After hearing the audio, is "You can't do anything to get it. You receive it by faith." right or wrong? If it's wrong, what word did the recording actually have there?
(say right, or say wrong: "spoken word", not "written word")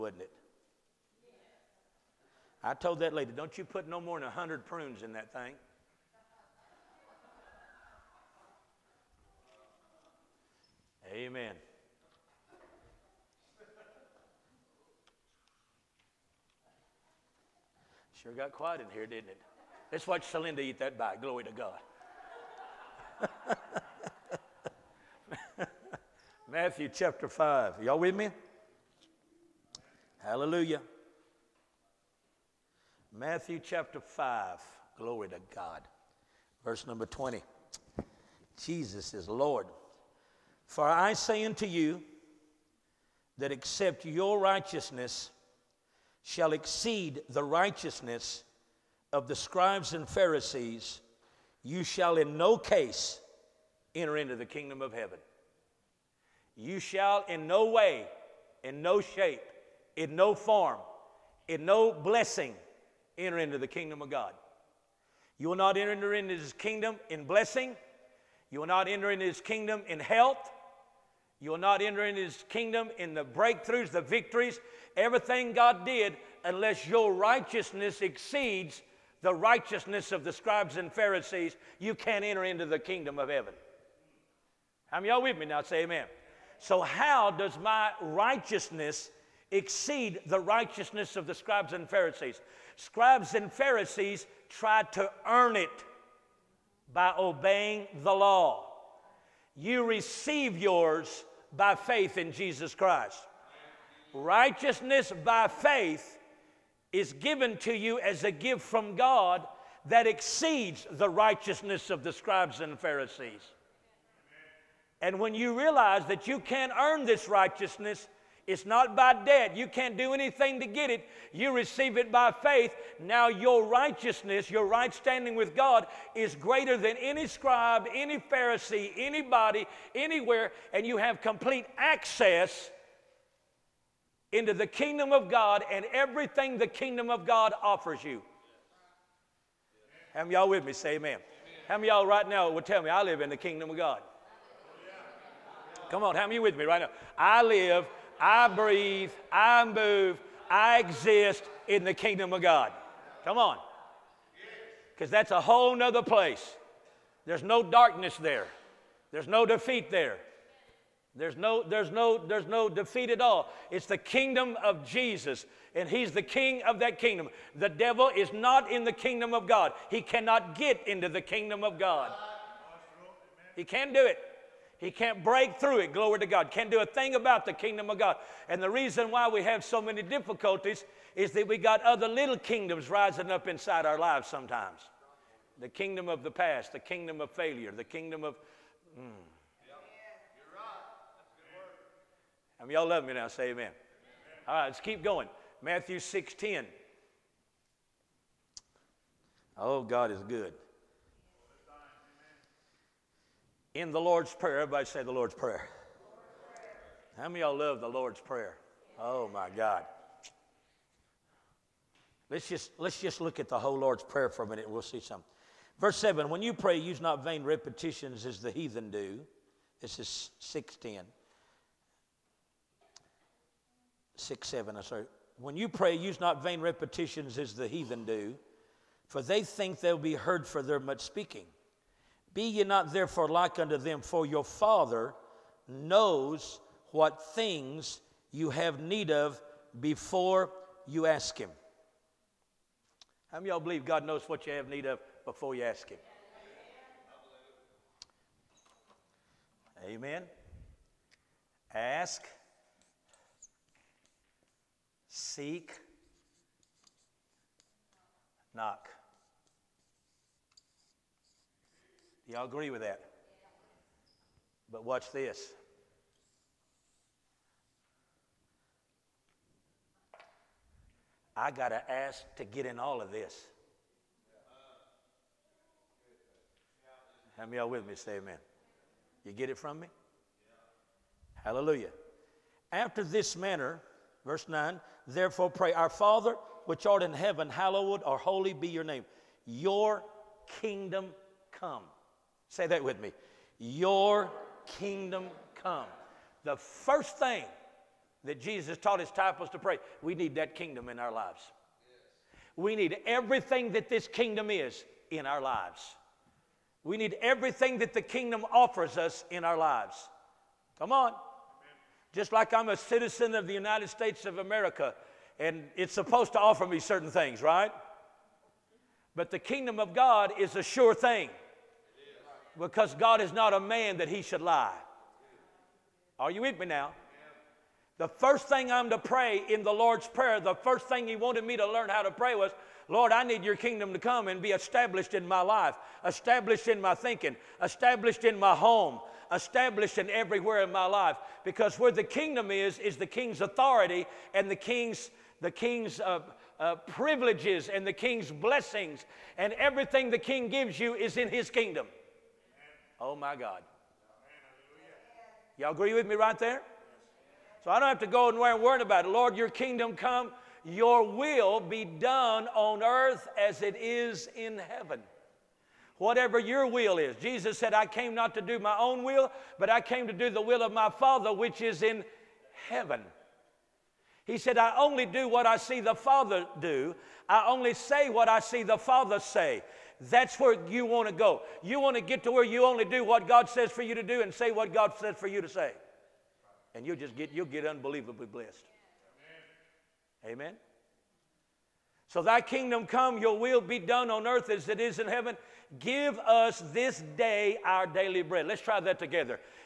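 right.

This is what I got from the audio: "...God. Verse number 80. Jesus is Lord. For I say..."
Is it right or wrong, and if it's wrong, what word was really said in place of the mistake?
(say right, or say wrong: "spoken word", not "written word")
wrong: "20", not "80".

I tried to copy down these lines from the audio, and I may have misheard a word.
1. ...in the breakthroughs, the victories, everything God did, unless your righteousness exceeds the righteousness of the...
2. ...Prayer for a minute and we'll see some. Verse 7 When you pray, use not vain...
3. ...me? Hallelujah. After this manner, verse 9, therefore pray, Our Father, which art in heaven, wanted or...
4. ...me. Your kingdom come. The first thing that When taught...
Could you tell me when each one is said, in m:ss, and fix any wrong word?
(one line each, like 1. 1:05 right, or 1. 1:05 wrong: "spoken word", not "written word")
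1. 1:12 right
2. 3:34 right
3. 4:39 wrong: "hallowed", not "wanted"
4. 4:53 wrong: "Jesus", not "When".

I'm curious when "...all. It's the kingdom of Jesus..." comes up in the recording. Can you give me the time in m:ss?
2:43.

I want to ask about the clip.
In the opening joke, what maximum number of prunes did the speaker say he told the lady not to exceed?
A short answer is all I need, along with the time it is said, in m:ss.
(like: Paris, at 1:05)
100, at 0:04.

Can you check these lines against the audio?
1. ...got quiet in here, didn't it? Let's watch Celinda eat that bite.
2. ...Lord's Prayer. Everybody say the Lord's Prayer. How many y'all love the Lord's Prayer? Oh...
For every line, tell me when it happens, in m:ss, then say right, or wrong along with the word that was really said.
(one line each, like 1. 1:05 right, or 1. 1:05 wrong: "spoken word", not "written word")
1. 0:18 right
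2. 3:23 right.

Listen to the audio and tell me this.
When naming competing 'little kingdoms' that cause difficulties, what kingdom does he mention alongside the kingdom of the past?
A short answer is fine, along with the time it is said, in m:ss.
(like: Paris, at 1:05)
kingdom of failure, at 3:06.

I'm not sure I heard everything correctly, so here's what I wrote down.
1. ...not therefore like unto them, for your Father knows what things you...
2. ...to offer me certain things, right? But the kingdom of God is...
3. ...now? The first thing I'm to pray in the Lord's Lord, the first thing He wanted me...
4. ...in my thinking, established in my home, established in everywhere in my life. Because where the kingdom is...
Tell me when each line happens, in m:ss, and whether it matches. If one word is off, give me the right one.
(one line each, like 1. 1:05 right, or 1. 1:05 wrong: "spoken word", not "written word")
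1. 3:52 right
2. 5:16 right
3. 5:26 wrong: "Prayer", not "Lord"
4. 5:36 right.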